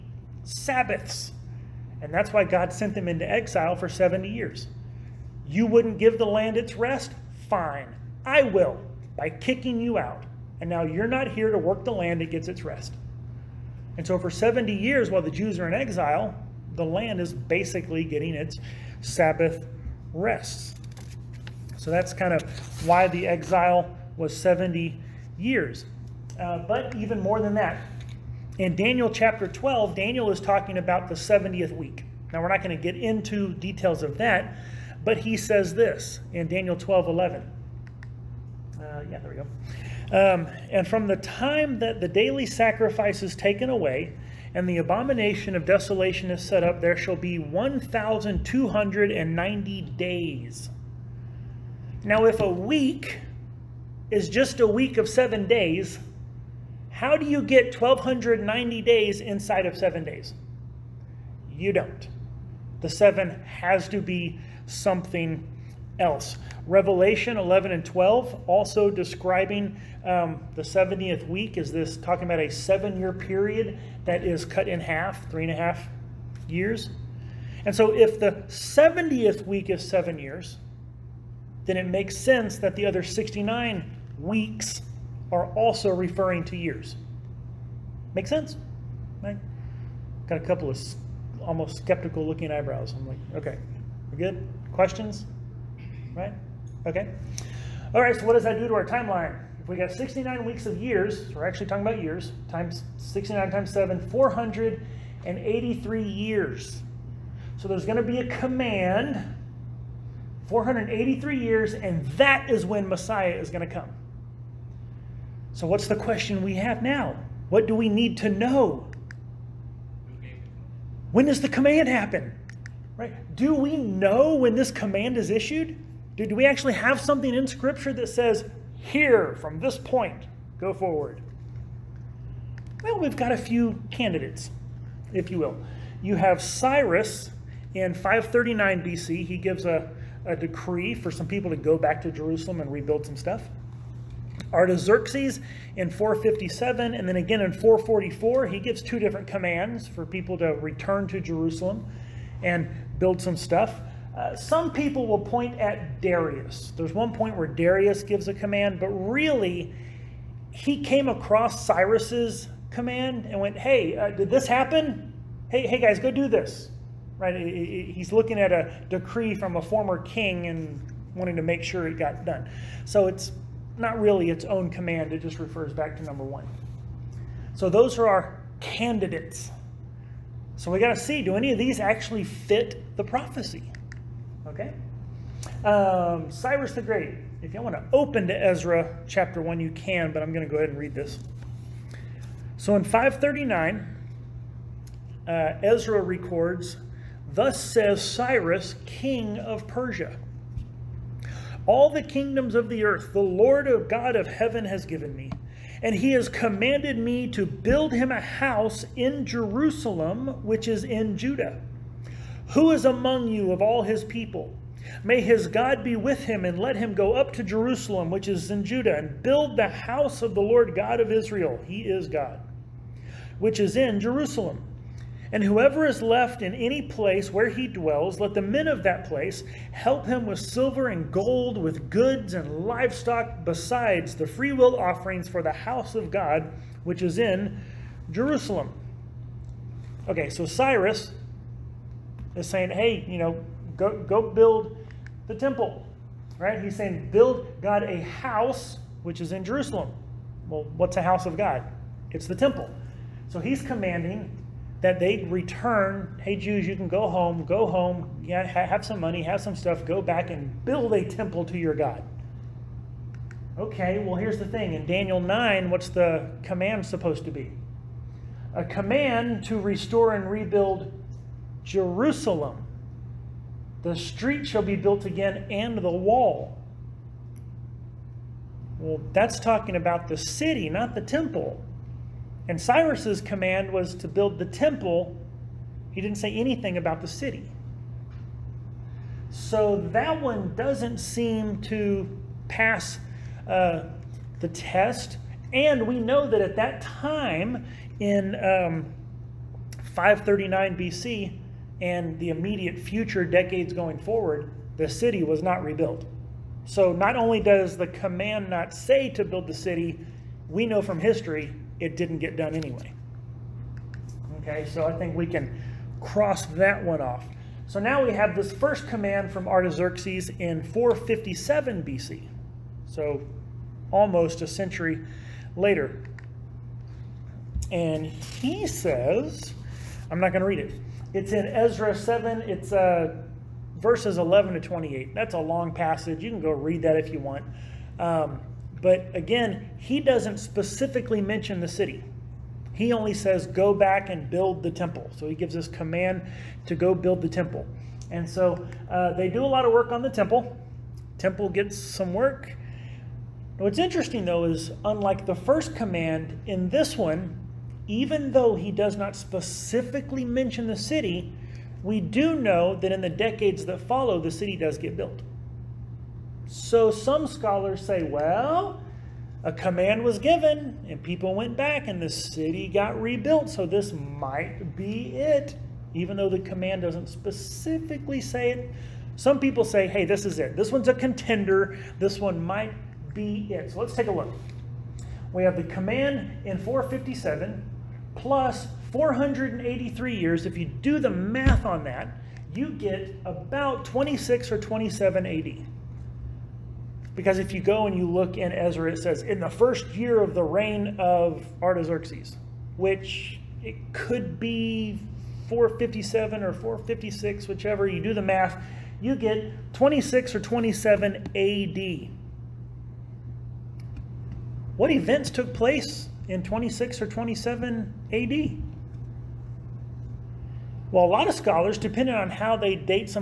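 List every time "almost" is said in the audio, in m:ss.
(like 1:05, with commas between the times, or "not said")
1:31, 5:23.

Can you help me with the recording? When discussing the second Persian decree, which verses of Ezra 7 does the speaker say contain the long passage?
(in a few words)
11 to 28.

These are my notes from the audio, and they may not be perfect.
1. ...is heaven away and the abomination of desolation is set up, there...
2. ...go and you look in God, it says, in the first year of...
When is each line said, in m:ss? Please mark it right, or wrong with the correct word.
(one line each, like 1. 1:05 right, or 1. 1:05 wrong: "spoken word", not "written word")
1. 0:43 wrong: "taken", not "heaven"
2. 6:37 wrong: "Ezra", not "God".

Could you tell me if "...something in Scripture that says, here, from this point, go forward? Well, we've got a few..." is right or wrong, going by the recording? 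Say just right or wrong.
right.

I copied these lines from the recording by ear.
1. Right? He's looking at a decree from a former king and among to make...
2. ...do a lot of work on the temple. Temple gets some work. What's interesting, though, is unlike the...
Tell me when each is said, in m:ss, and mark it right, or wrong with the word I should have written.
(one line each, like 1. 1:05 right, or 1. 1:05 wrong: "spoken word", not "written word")
1. 2:47 wrong: "wanting", not "among"
2. 5:49 right.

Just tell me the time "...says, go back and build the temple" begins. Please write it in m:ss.
5:43.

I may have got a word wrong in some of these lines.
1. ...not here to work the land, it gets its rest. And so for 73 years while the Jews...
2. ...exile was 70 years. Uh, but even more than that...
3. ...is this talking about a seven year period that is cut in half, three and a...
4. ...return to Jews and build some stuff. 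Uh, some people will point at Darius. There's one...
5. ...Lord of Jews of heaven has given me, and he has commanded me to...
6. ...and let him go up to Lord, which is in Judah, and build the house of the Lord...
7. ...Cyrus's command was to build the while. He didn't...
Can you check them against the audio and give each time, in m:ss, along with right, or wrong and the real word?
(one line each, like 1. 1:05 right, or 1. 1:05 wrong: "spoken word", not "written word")
1. 0:11 wrong: "70", not "73"
2. 0:23 right
3. 1:11 right
4. 2:30 wrong: "Jerusalem", not "Jews"
5. 3:23 wrong: "God", not "Jews"
6. 3:36 wrong: "Jerusalem", not "Lord"
7. 4:42 wrong: "temple", not "while".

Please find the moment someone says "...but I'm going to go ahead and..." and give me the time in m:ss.
3:10.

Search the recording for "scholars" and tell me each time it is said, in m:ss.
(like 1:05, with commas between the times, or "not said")
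6:07, 7:01.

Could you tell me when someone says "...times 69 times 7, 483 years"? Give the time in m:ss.
1:42.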